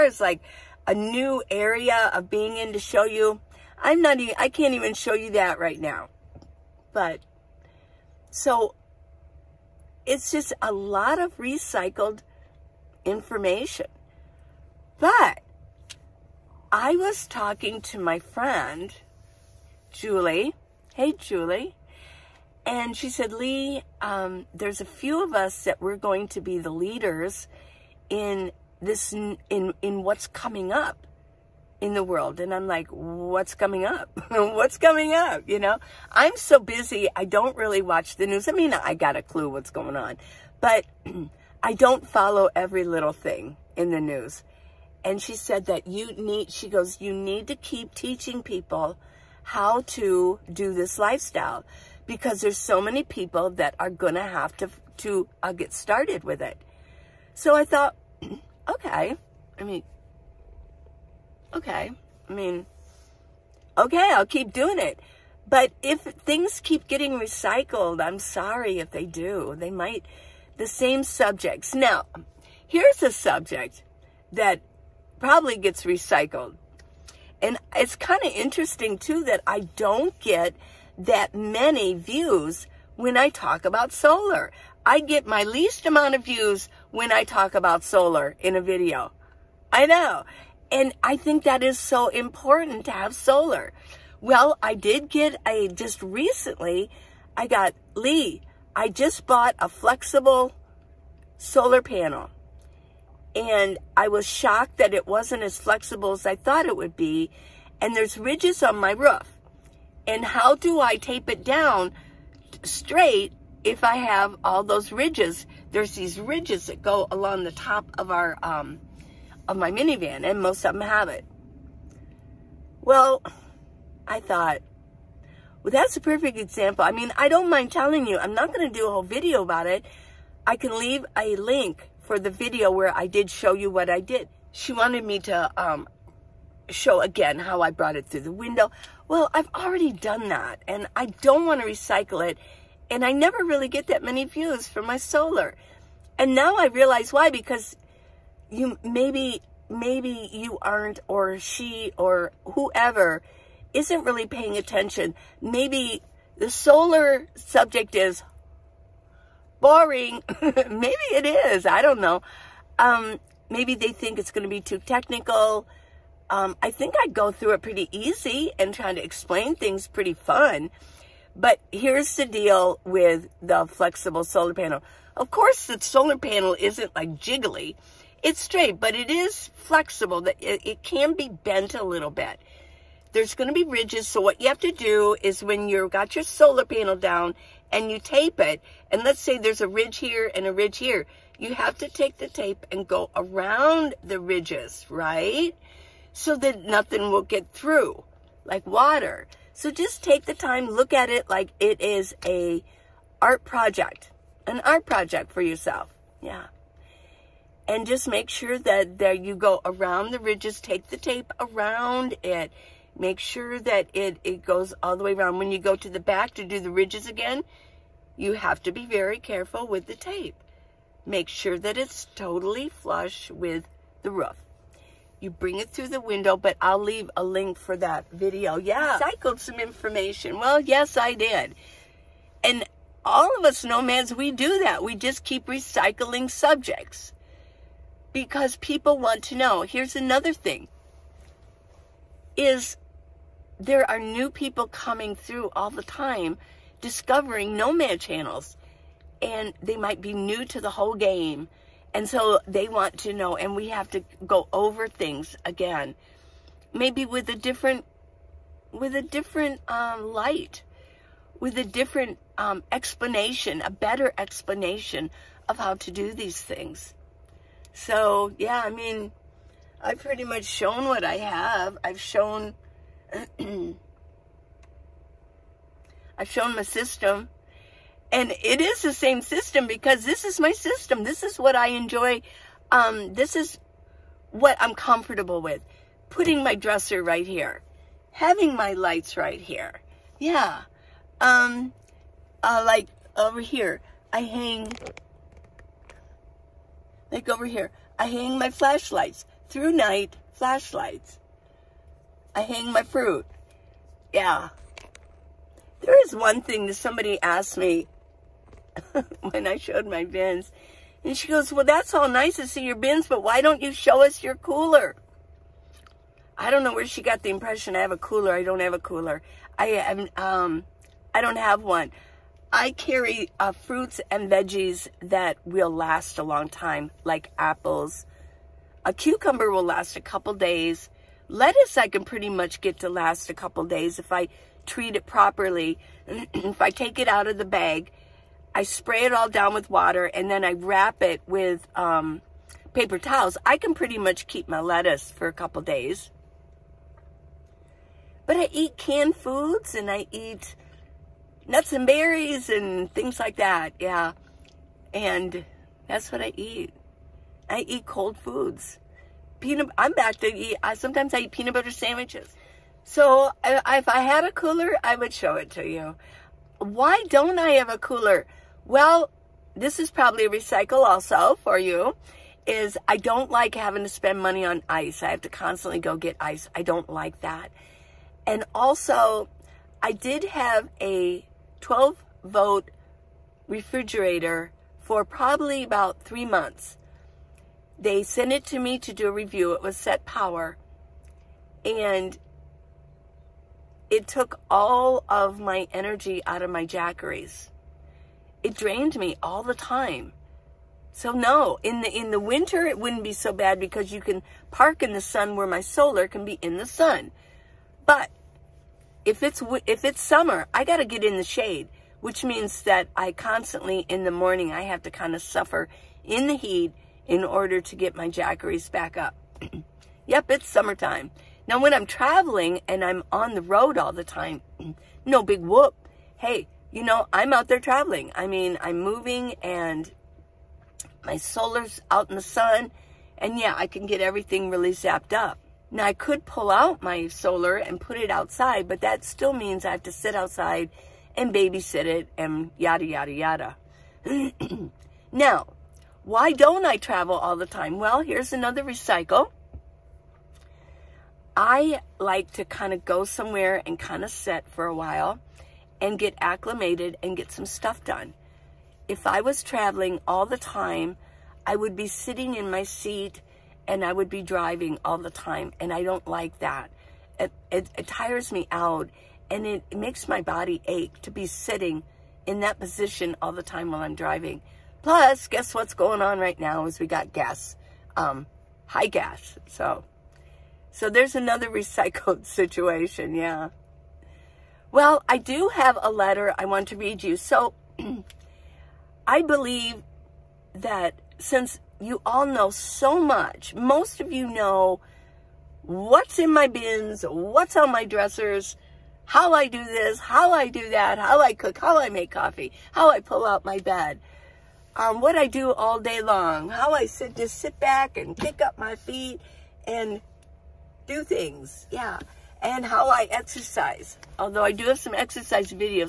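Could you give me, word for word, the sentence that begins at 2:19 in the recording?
Well, I've already done that and I don't want to recycle it.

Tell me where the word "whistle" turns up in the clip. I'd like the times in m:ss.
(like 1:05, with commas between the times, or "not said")
not said.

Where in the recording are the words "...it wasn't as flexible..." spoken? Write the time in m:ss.
1:44.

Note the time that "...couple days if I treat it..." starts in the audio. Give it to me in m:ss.
5:33.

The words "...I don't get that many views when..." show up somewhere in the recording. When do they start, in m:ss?
1:19.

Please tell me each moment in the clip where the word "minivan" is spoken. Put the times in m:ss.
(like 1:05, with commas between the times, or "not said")
1:59.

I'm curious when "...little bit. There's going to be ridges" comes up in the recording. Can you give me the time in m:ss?
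3:01.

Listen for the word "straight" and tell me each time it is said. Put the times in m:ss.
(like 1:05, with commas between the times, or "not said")
1:52, 2:58.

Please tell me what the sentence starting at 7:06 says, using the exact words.
Hey, you know, I'm out there traveling.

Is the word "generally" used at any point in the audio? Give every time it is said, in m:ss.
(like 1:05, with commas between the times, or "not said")
not said.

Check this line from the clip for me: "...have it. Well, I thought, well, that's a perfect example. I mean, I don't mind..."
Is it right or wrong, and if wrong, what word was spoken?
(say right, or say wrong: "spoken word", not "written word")
right.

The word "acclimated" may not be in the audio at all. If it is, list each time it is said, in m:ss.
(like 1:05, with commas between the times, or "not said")
7:36.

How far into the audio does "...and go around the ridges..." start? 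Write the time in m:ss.
3:12.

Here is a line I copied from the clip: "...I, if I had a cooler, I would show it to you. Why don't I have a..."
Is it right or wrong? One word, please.
right.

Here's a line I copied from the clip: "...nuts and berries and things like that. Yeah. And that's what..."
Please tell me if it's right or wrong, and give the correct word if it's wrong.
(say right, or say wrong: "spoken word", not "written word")
right.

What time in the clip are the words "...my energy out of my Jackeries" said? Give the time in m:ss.
6:35.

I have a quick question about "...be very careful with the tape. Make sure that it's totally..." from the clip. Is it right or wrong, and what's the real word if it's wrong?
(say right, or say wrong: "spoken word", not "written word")
right.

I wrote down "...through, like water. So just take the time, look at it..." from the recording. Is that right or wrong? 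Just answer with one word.
right.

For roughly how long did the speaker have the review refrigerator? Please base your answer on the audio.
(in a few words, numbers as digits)
about 3 months.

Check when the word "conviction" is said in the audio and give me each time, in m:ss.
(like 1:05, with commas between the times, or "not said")
not said.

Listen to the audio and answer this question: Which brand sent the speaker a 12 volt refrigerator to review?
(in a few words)
SetPower.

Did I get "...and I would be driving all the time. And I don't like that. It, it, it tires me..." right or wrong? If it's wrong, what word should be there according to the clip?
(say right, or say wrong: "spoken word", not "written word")
right.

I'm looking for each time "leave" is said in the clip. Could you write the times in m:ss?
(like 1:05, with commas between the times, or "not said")
2:10, 3:46.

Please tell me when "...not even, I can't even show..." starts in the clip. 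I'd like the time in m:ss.
0:04.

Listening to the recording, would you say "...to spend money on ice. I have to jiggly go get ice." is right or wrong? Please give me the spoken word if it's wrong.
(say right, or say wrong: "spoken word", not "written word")
wrong: "constantly", not "jiggly".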